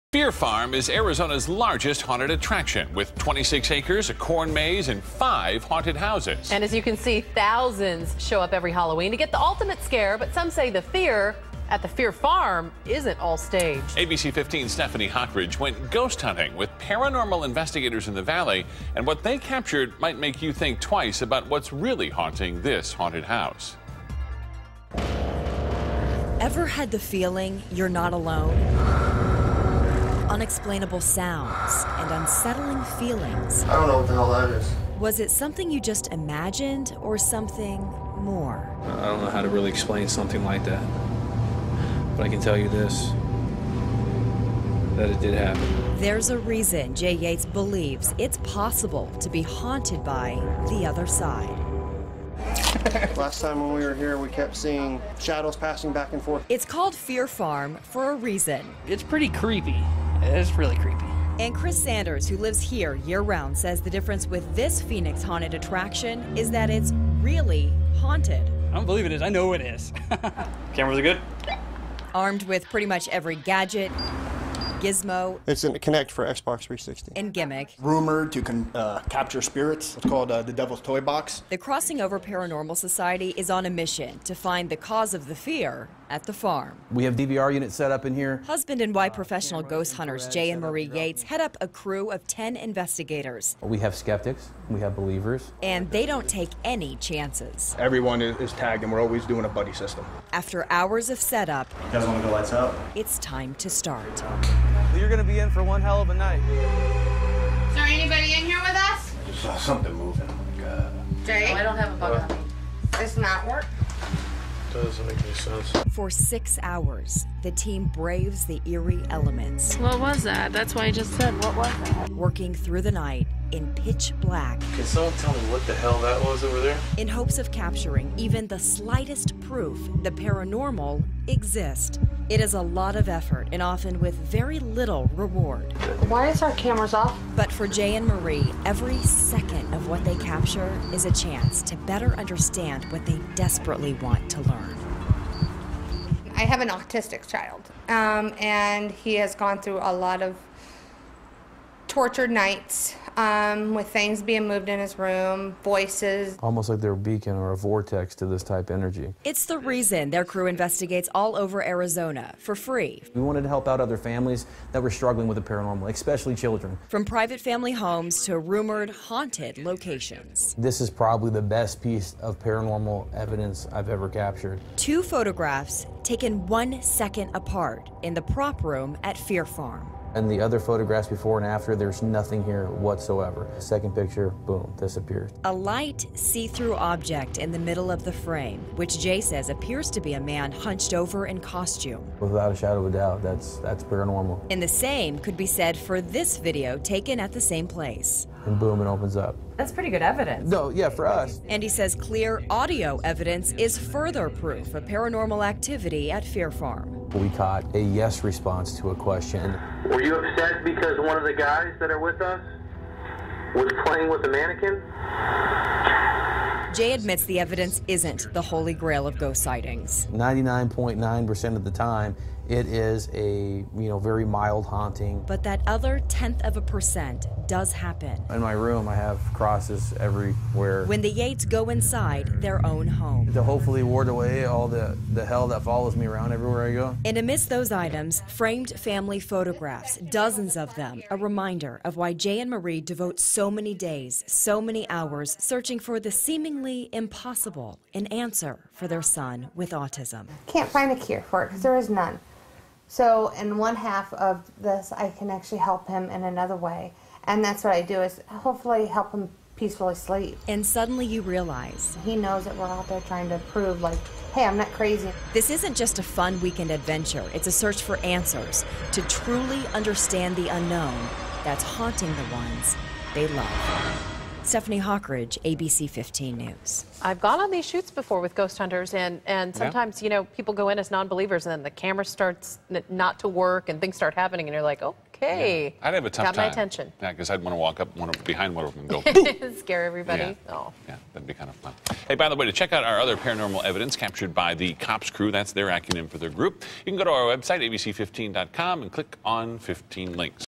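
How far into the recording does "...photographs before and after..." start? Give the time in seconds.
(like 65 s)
180 s.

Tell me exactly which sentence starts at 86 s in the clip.
We have DVR units set up in here.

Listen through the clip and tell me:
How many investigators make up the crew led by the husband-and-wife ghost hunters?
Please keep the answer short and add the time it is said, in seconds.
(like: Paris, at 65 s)
10, at 92 s.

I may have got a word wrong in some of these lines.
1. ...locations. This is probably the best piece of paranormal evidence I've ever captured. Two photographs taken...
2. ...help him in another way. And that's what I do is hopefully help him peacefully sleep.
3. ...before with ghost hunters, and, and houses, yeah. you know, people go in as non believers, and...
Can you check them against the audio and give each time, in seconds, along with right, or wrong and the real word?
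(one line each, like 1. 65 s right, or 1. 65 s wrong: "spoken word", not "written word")
1. 169 s right
2. 255 s right
3. 277 s wrong: "sometimes", not "houses".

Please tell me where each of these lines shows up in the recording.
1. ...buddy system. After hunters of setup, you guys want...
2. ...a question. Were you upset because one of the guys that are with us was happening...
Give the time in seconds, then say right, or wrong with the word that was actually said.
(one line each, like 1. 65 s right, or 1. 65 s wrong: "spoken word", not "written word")
1. 99 s wrong: "hours", not "hunters"
2. 208 s wrong: "playing", not "happening".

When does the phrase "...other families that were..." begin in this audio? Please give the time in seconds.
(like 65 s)
163 s.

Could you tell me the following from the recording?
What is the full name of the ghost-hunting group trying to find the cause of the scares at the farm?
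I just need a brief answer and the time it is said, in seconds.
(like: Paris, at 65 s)
Crossing Over Paranormal Society, at 81 s.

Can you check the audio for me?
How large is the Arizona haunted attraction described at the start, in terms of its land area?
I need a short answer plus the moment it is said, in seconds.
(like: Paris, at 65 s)
26 acres, at 3 s.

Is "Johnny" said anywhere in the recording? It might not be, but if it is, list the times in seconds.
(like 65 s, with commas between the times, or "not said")
not said.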